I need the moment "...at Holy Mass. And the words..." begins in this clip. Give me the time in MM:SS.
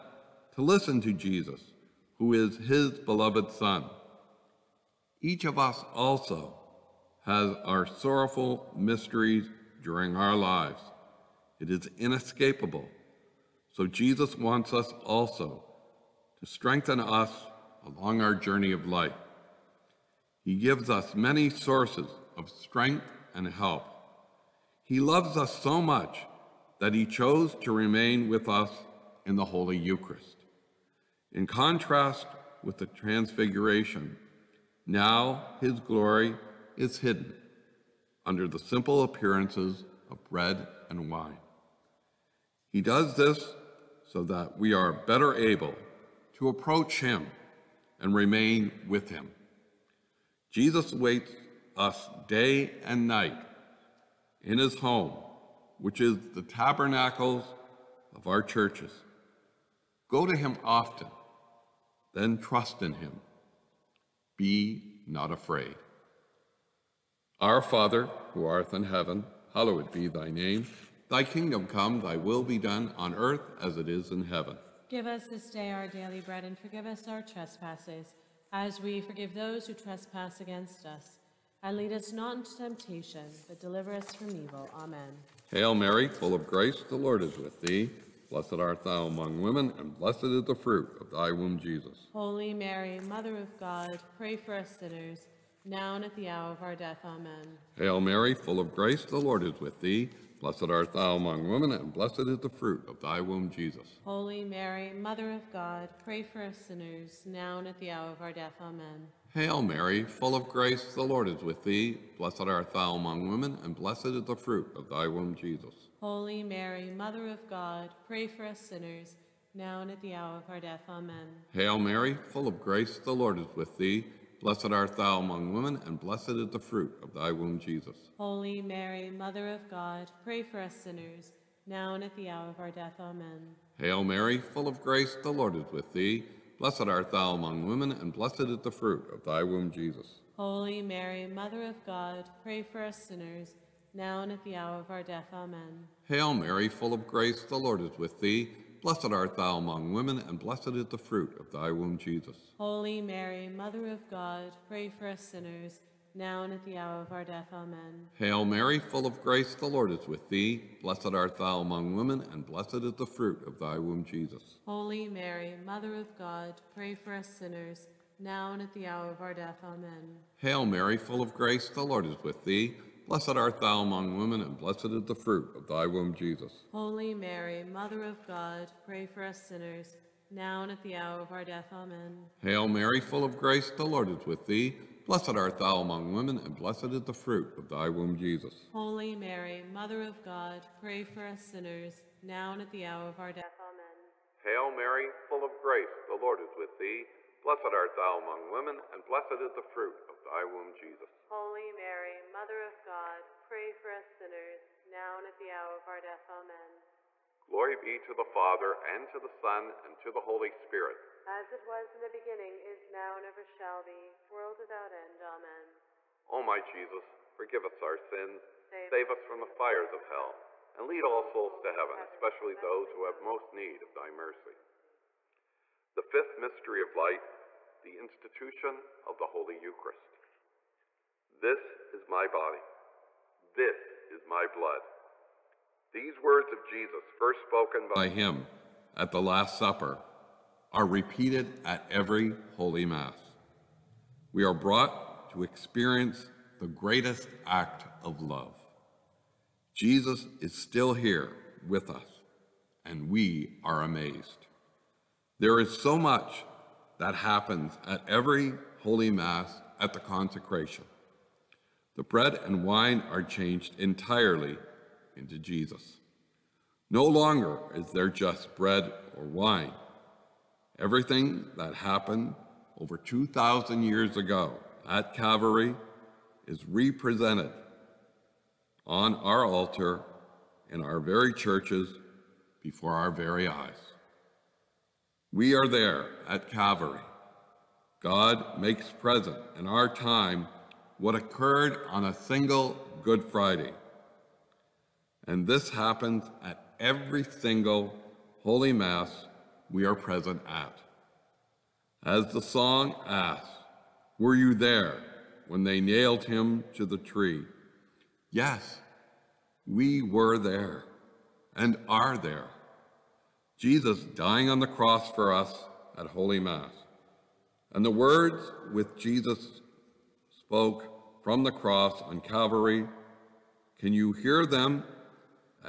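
05:15.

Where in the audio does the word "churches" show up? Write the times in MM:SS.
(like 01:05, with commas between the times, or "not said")
00:58, 04:41.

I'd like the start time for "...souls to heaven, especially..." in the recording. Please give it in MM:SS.
03:41.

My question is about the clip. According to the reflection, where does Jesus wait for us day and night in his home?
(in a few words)
tabernacles.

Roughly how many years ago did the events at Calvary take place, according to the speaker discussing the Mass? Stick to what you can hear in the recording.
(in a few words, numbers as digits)
over 2,000 years.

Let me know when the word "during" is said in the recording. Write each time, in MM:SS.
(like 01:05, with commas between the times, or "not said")
00:09.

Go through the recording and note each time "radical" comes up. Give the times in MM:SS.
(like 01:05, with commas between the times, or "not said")
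not said.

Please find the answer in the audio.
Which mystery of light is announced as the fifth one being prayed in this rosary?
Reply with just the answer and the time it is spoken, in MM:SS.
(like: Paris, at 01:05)
Institution of the Holy Eucharist, at 03:47.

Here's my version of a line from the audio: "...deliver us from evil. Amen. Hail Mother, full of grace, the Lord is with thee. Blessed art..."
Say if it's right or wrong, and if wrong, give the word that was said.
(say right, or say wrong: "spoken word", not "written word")
wrong: "Mary", not "Mother".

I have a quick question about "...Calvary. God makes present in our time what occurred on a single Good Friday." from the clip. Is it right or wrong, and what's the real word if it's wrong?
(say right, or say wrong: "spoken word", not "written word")
right.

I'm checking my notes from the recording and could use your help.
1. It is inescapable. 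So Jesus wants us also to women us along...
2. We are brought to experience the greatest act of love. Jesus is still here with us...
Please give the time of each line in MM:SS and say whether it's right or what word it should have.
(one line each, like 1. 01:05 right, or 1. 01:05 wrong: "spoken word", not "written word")
1. 00:11 wrong: "strengthen", not "women"
2. 04:04 right.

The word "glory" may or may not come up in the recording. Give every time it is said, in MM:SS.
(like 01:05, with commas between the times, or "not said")
00:35, 03:27.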